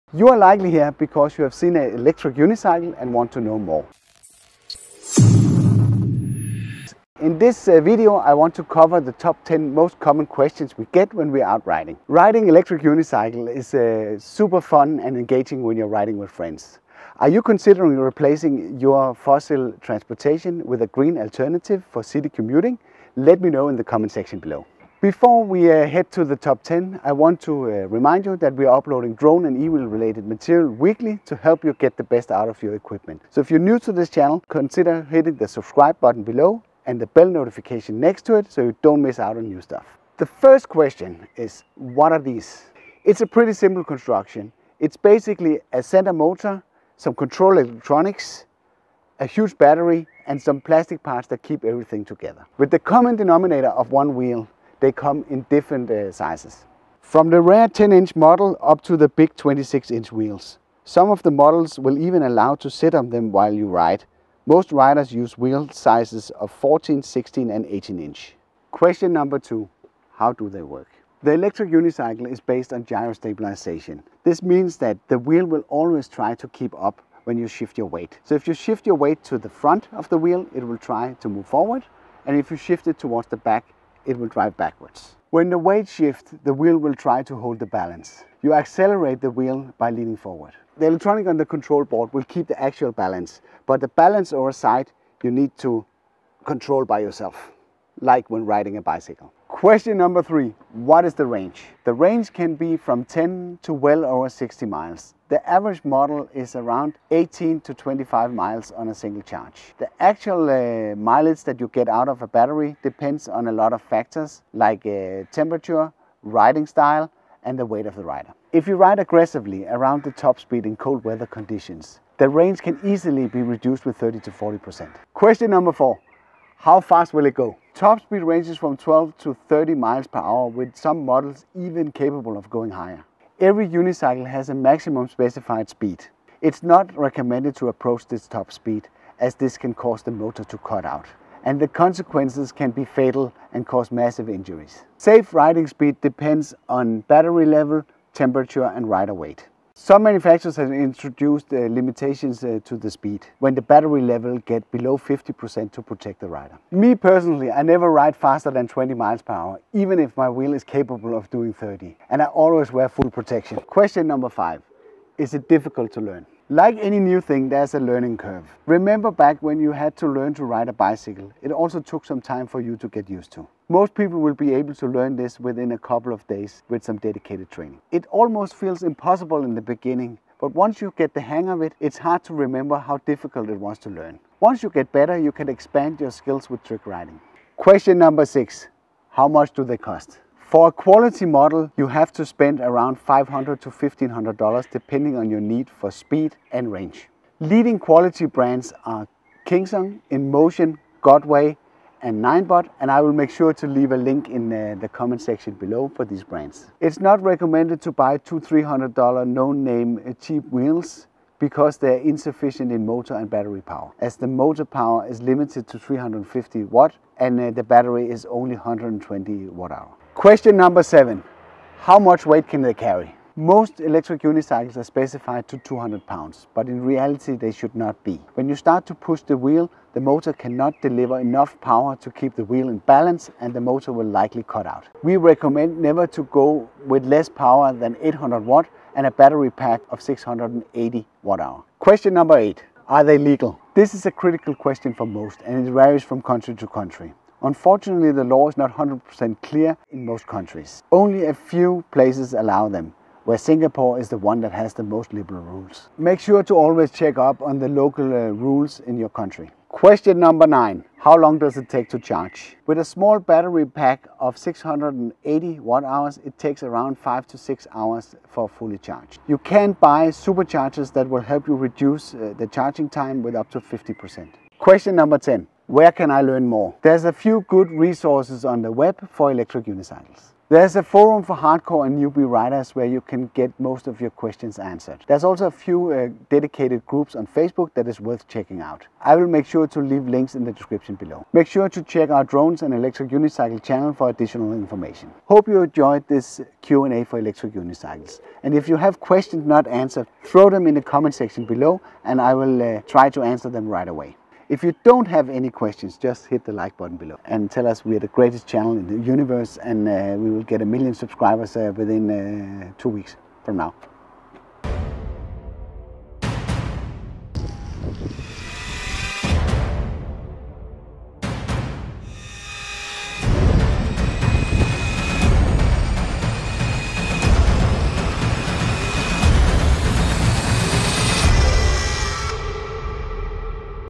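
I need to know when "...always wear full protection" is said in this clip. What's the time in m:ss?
2:42.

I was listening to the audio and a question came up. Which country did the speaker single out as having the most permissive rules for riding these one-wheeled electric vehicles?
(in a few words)
Singapore.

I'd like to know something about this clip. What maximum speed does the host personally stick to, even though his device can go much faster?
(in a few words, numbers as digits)
20 miles per hour.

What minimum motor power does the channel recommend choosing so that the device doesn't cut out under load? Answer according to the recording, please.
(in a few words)
800 watt.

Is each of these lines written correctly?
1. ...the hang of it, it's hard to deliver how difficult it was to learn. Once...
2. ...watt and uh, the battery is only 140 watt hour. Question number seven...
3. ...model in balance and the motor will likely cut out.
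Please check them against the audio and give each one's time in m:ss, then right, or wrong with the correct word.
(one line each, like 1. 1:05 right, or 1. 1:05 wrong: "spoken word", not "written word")
1. 3:01 wrong: "remember", not "deliver"
2. 3:36 wrong: "120", not "140"
3. 3:52 wrong: "wheel", not "model".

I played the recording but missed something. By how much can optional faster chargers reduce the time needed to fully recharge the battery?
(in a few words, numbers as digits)
up to 50%.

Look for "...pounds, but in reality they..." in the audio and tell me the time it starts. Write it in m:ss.
3:46.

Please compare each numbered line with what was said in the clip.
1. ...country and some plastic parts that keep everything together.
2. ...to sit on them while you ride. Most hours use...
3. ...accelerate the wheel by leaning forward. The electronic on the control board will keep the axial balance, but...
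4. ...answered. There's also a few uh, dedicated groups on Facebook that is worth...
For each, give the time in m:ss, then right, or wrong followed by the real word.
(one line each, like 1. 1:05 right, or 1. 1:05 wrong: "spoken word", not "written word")
1. 0:49 wrong: "battery", not "country"
2. 1:02 wrong: "riders", not "hours"
3. 1:28 right
4. 4:44 right.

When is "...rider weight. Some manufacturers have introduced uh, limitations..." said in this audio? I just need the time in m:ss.
2:28.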